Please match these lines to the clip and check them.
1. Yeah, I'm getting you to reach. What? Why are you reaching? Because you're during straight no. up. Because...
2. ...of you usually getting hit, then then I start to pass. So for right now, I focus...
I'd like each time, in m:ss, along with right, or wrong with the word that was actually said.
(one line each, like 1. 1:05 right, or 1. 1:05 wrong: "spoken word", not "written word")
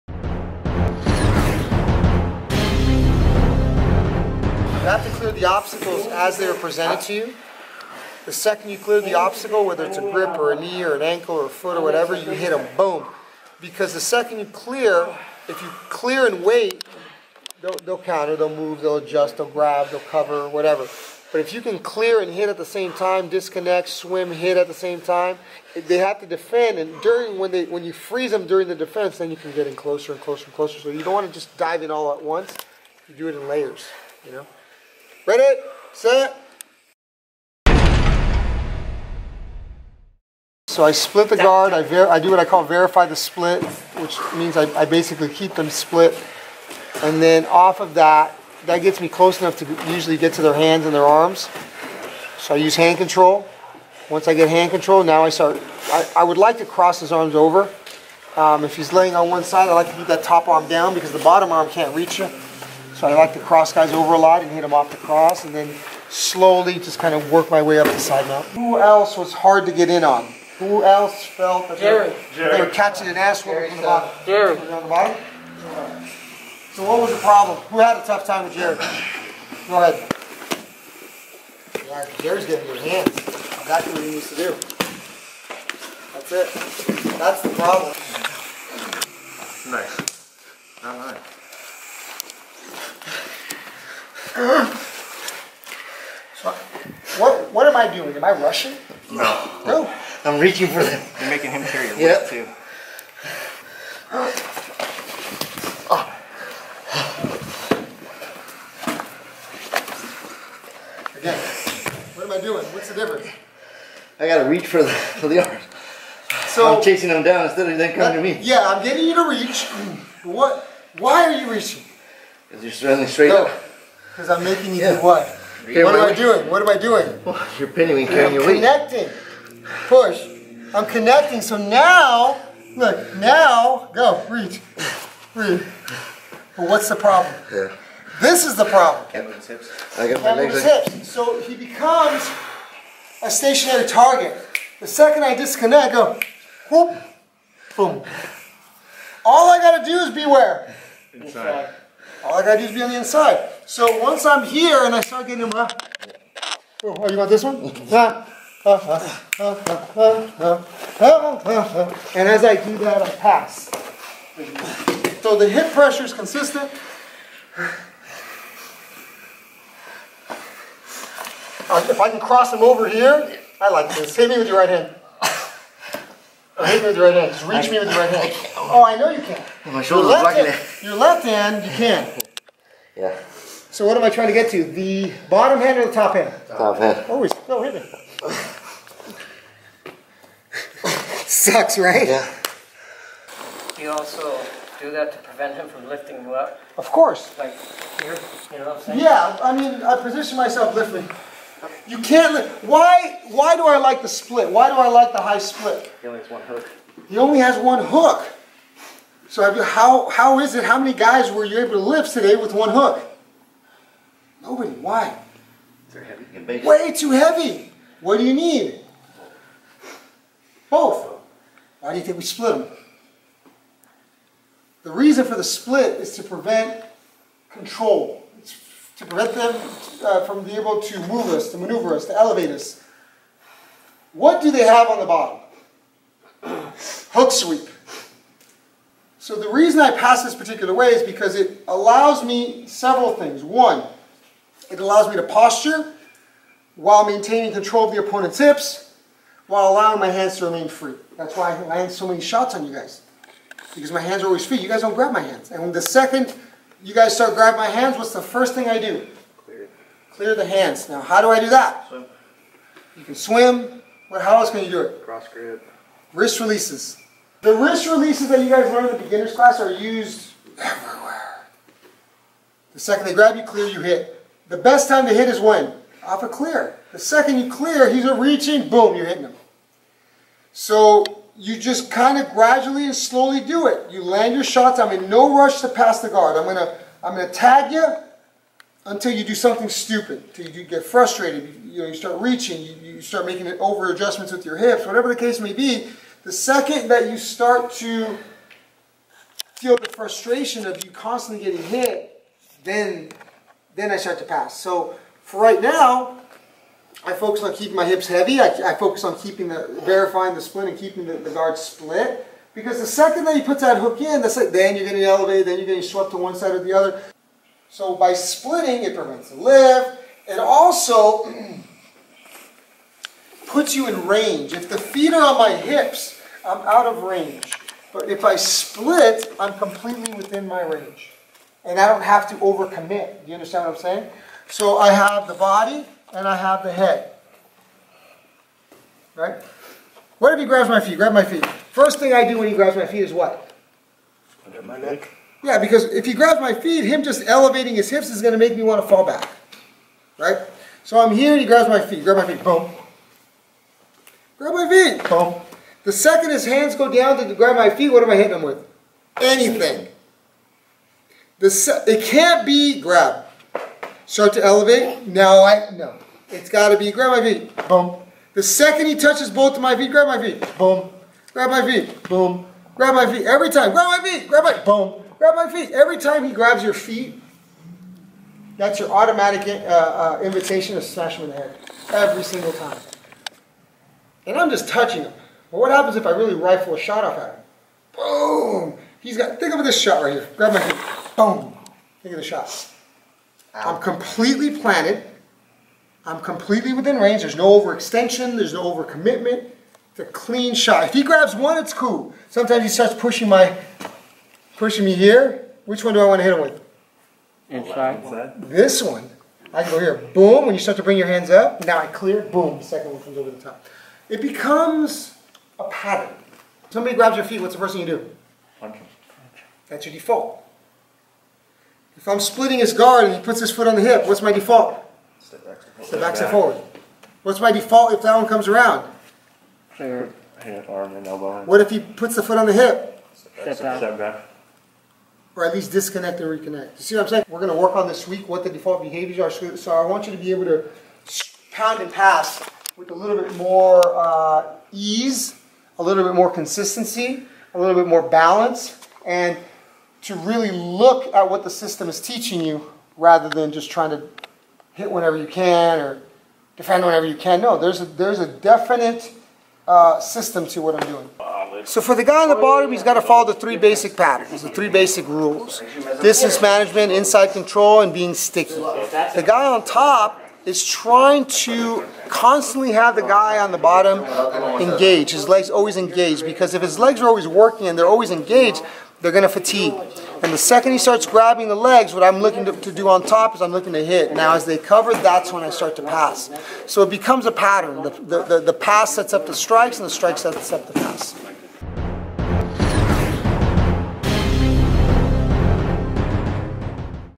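1. 1:58 wrong: "running", not "during"
2. 5:00 wrong: "constantly", not "usually".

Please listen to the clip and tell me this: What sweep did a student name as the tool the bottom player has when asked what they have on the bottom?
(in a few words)
Hook sweep.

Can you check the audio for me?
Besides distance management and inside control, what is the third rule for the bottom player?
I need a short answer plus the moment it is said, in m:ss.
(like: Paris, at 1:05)
being sticky, at 7:47.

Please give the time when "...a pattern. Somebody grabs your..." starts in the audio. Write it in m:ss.
6:55.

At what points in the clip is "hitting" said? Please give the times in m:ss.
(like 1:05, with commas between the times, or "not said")
4:39, 5:58.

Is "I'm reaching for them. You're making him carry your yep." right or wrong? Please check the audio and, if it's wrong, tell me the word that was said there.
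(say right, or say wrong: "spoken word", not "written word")
right.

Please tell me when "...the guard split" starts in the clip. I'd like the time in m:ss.
5:11.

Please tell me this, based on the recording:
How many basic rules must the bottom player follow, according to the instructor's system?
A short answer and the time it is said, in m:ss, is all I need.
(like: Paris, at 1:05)
3, at 7:44.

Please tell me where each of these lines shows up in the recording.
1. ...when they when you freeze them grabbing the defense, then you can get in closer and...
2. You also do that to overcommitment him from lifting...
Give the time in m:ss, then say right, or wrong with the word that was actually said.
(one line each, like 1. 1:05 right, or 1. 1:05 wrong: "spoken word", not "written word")
1. 0:27 wrong: "during", not "grabbing"
2. 3:13 wrong: "prevent", not "overcommitment".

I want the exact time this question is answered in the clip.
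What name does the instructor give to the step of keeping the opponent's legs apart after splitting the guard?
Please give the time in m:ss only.
0:42.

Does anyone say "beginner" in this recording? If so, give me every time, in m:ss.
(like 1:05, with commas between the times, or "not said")
4:29.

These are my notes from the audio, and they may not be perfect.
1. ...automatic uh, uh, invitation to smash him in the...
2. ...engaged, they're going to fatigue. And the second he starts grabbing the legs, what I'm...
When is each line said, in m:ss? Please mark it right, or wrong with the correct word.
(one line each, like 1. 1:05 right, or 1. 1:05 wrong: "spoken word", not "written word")
1. 6:18 right
2. 7:58 right.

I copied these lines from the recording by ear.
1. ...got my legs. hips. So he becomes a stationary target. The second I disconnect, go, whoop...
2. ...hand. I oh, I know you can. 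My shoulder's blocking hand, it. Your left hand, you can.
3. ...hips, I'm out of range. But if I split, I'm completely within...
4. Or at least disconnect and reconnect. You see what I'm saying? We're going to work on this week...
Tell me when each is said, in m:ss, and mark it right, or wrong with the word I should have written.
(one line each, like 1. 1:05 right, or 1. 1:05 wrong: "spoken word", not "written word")
1. 2:20 right
2. 2:58 right
3. 5:25 right
4. 7:15 right.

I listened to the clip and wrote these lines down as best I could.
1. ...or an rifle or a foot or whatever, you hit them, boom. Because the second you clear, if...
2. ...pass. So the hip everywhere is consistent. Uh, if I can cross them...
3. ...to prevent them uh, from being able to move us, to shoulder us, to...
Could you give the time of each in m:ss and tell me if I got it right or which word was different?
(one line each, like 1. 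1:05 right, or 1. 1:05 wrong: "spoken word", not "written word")
1. 0:10 wrong: "ankle", not "rifle"
2. 2:43 wrong: "pressure", not "everywhere"
3. 3:49 wrong: "maneuver", not "shoulder".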